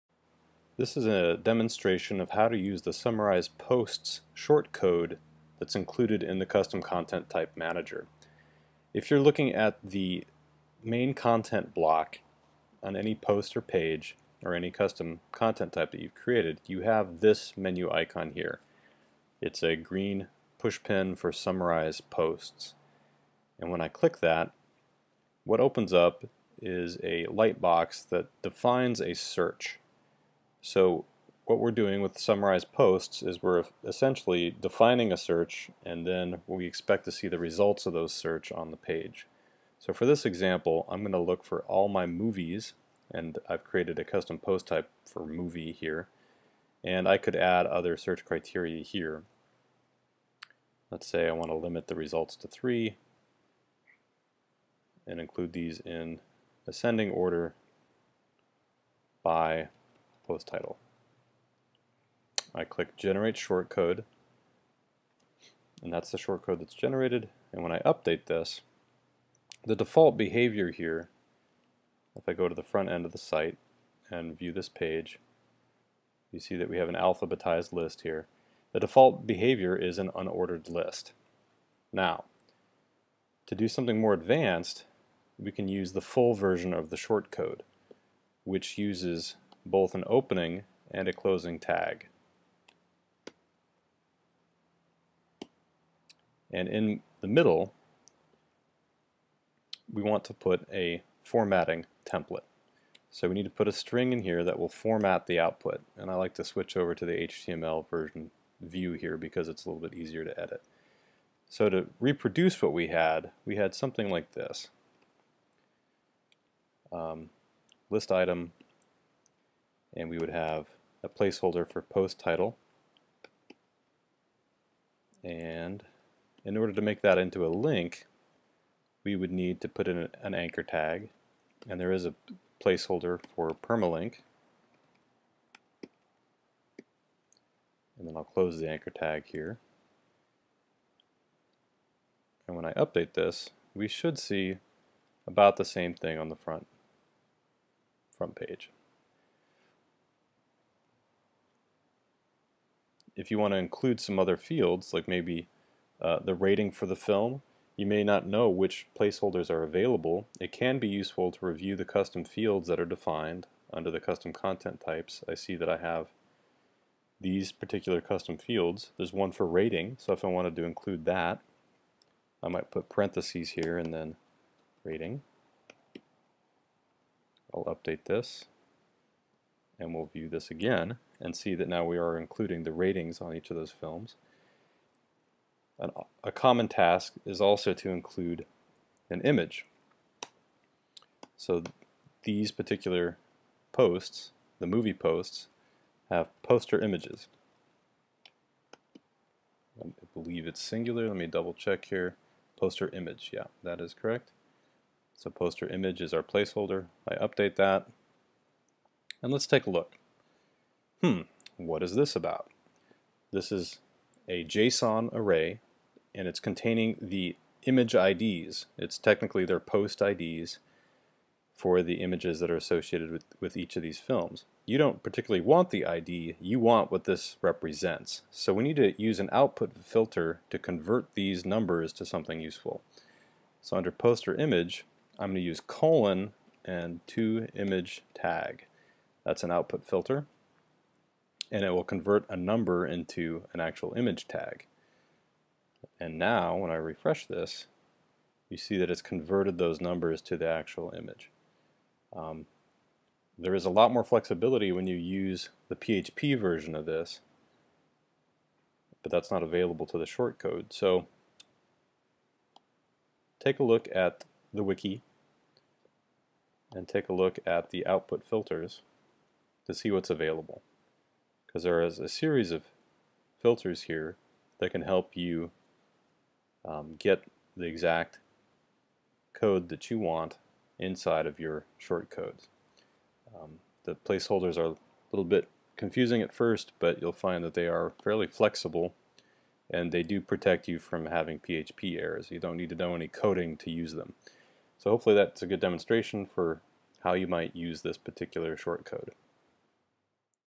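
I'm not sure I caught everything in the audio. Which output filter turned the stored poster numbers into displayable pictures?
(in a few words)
to image tag.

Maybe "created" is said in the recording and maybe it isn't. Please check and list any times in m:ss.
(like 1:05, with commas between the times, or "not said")
0:16, 0:43.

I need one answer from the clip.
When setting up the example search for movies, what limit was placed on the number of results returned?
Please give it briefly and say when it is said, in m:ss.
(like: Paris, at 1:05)
3, at 0:52.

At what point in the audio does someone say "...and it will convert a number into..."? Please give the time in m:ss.
4:01.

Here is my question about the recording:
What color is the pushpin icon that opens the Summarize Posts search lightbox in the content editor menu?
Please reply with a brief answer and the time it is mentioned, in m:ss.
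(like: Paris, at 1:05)
green, at 0:19.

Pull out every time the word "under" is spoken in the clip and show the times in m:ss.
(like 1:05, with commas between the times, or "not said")
2:43, 3:53.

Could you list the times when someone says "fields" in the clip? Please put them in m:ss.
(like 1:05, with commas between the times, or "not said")
2:34, 2:42, 2:48.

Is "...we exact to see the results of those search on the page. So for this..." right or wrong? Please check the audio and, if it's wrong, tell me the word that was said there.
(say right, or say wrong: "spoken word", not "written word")
wrong: "expect", not "exact".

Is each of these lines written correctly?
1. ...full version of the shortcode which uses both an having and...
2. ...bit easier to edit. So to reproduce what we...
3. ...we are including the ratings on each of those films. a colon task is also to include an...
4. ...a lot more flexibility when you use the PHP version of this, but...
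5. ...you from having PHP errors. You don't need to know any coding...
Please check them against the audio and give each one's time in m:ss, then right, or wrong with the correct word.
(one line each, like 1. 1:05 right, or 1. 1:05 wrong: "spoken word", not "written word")
1. 1:25 wrong: "opening", not "having"
2. 1:49 right
3. 3:01 wrong: "common", not "colon"
4. 4:13 right
5. 4:50 right.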